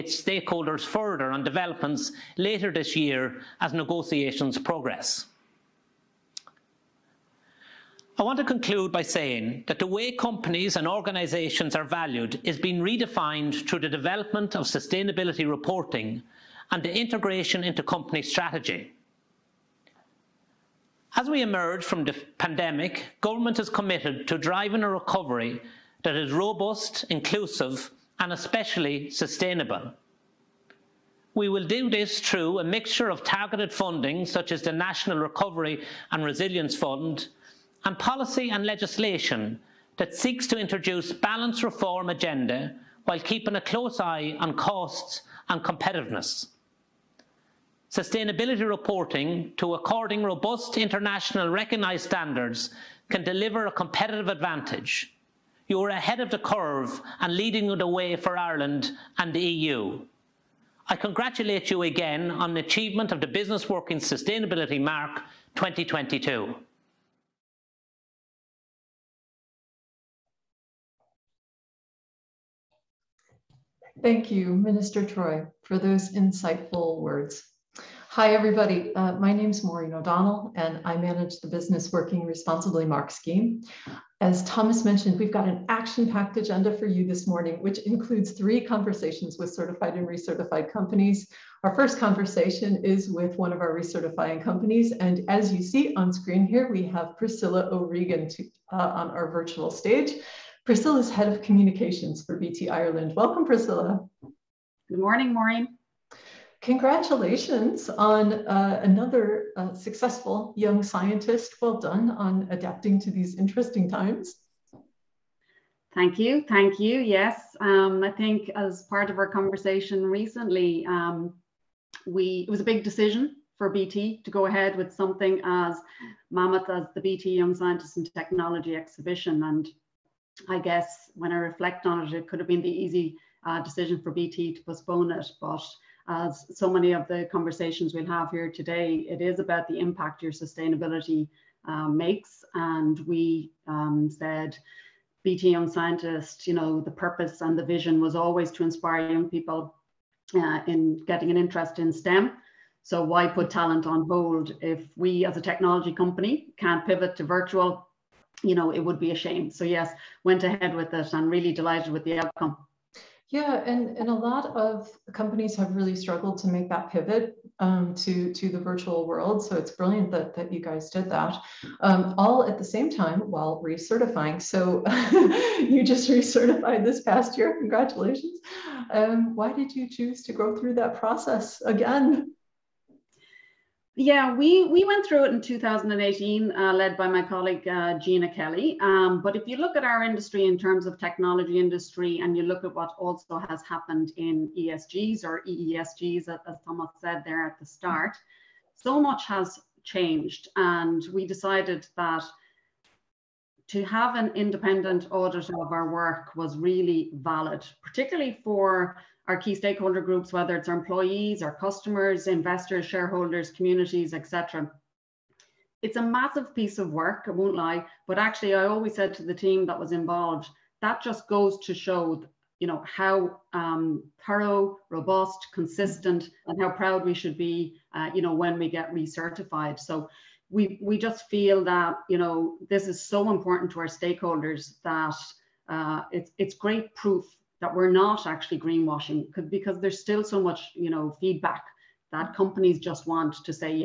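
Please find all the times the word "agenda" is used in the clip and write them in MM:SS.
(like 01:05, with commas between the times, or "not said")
00:42, 01:26.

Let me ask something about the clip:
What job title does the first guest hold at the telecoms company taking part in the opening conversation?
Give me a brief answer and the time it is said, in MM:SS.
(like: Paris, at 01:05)
Head of Communications, at 01:41.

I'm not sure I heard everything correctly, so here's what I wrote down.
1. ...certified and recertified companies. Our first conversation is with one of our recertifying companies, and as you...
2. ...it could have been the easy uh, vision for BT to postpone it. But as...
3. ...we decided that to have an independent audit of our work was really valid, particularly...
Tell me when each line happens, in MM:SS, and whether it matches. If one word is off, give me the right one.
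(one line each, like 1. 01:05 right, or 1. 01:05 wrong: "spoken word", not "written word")
1. 01:29 right
2. 02:12 wrong: "decision", not "vision"
3. 03:21 right.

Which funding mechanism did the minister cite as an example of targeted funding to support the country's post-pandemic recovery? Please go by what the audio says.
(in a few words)
National Recovery and Resilience Fund.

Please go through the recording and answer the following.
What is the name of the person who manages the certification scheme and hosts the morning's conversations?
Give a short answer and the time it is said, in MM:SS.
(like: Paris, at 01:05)
Maureen O'Donnell, at 01:19.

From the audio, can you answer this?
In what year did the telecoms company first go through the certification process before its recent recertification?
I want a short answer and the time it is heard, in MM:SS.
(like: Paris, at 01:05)
2018, at 03:05.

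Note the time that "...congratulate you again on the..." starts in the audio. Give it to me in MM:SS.
01:00.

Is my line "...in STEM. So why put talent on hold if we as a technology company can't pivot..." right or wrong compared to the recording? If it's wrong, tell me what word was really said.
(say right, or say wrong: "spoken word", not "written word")
right.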